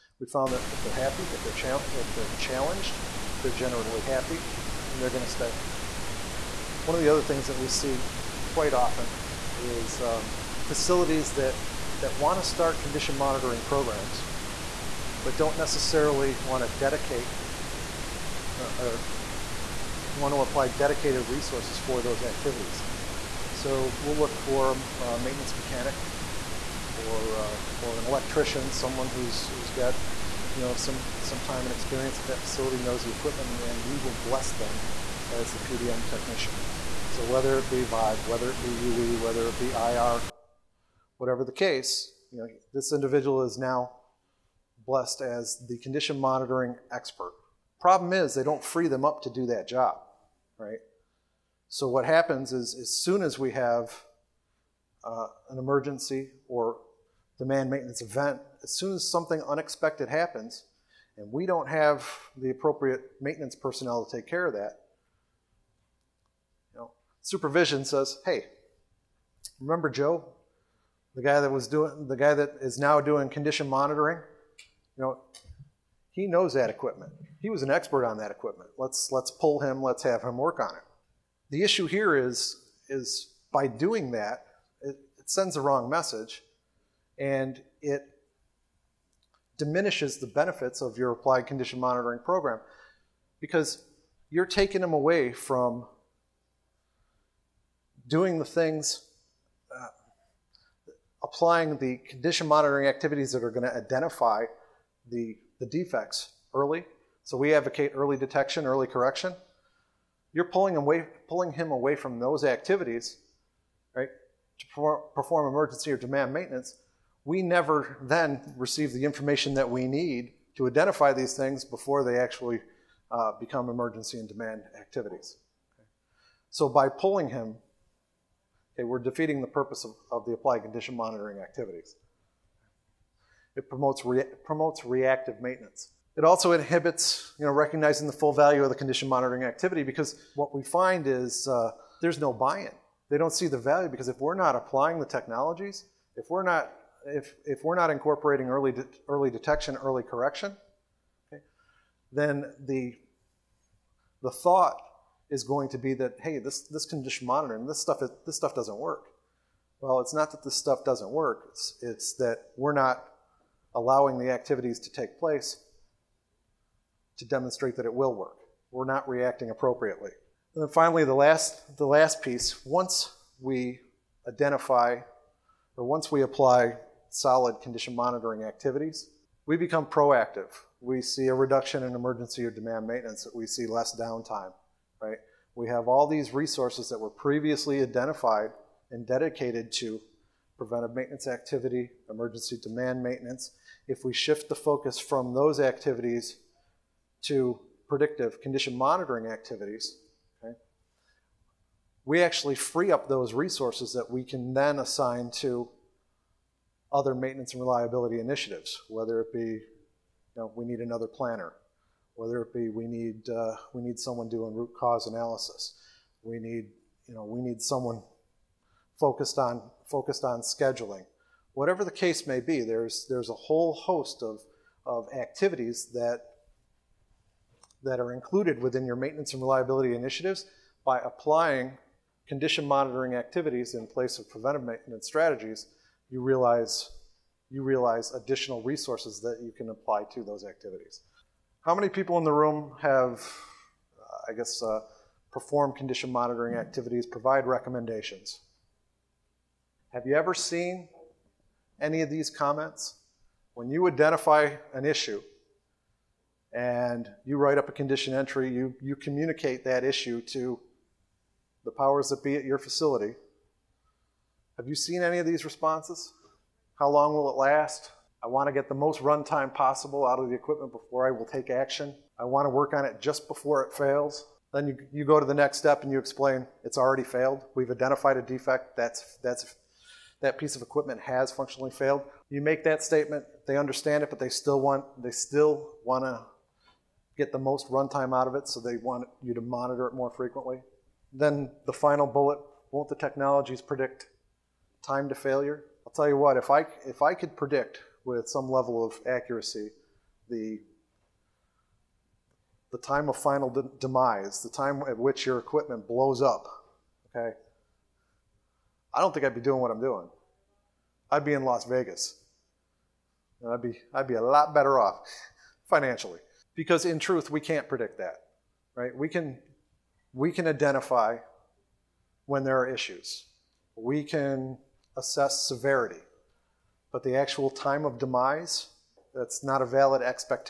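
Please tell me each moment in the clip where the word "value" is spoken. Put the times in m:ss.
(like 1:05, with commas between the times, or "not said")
2:18, 2:23.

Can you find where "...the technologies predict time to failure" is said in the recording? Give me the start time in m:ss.
4:52.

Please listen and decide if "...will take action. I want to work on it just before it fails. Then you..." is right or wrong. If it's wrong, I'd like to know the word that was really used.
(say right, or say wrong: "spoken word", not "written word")
right.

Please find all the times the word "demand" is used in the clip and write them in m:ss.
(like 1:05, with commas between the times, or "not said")
0:57, 1:55, 2:04, 3:02, 3:12.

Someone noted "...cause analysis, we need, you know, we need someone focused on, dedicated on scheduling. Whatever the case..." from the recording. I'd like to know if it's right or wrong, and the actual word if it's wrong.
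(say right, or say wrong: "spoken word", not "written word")
wrong: "focused", not "dedicated".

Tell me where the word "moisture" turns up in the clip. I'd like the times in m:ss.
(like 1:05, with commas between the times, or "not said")
not said.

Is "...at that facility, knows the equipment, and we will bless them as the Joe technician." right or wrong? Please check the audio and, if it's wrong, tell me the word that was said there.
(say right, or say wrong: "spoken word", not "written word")
wrong: "PDM", not "Joe".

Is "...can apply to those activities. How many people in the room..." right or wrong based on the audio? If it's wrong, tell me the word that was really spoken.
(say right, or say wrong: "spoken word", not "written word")
right.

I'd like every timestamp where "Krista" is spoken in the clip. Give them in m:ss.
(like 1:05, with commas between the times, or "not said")
not said.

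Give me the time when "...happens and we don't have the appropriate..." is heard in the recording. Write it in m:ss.
1:00.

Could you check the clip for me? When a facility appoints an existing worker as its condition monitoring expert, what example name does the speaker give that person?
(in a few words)
Joe.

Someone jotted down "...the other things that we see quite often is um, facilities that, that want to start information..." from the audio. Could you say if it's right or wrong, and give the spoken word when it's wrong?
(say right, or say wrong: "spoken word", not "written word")
wrong: "condition", not "information".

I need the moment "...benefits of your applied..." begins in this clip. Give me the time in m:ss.
1:30.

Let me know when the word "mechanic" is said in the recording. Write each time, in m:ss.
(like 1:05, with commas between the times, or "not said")
0:25.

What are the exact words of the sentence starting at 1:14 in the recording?
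You know, he knows that equipment.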